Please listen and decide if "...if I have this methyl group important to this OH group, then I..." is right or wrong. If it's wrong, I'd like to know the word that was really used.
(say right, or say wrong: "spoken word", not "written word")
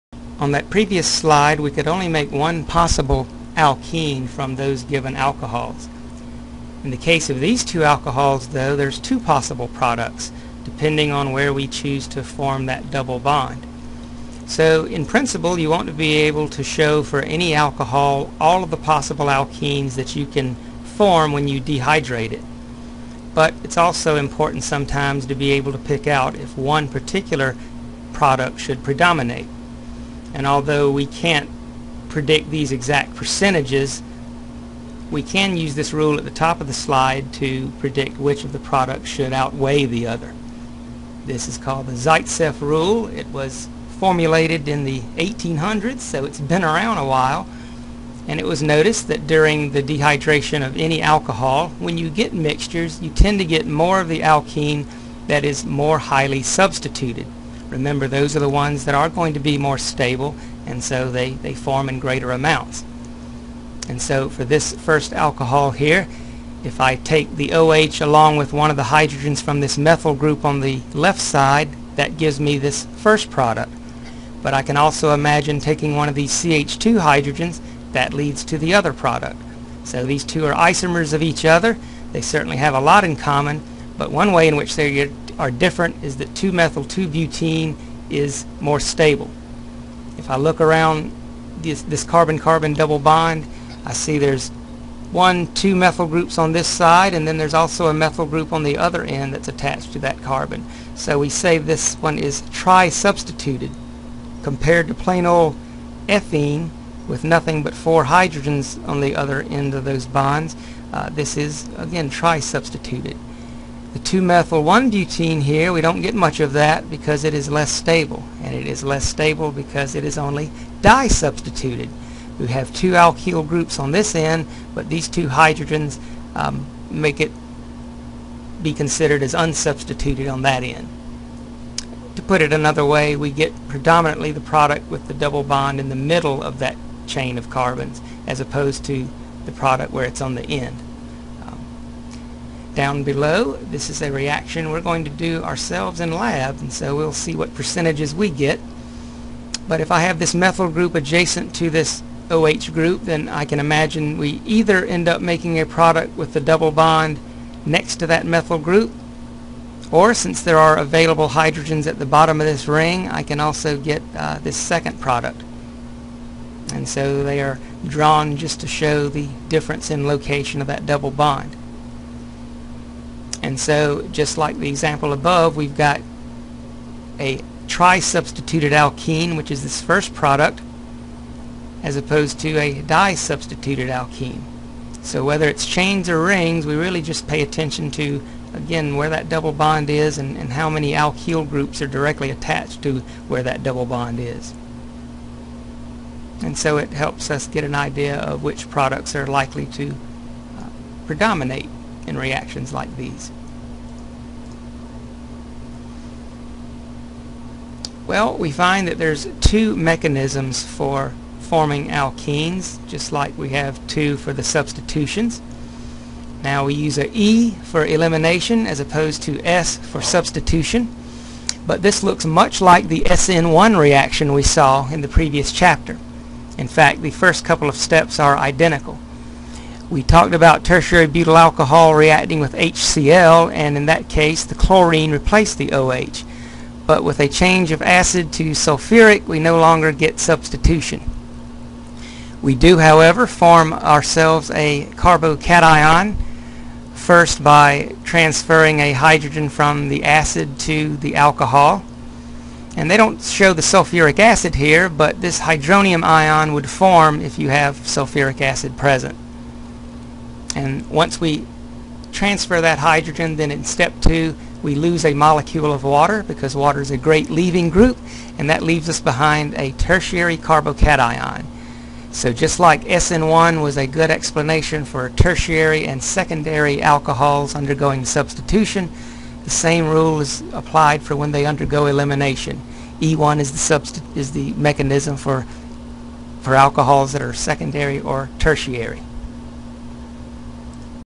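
wrong: "adjacent", not "important".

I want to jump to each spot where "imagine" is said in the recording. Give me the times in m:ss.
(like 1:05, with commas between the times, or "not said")
1:15, 2:33.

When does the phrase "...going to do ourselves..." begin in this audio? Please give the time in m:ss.
2:24.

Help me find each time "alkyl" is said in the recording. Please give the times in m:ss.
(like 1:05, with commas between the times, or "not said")
2:02, 3:10.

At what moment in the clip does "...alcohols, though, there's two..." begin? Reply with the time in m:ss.
0:07.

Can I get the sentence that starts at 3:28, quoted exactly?
Well, we find that there's two mechanisms for forming alkenes, just like we have two for the substitutions.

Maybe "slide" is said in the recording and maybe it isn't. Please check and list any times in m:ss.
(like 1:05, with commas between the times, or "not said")
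0:01, 0:36.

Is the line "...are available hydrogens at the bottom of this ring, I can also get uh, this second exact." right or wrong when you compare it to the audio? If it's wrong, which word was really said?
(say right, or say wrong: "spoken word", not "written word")
wrong: "product", not "exact".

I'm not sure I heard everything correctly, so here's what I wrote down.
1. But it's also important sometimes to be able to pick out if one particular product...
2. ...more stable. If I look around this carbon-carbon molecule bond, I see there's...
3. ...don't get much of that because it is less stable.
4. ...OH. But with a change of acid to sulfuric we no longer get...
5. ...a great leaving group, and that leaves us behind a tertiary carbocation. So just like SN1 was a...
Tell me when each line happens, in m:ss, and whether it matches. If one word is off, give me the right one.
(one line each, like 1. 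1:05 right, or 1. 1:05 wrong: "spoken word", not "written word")
1. 0:23 right
2. 1:28 wrong: "double", not "molecule"
3. 1:55 right
4. 3:55 right
5. 4:26 right.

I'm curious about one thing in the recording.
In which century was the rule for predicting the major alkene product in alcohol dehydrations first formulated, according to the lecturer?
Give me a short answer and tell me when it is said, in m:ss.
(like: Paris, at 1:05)
1800s, at 0:45.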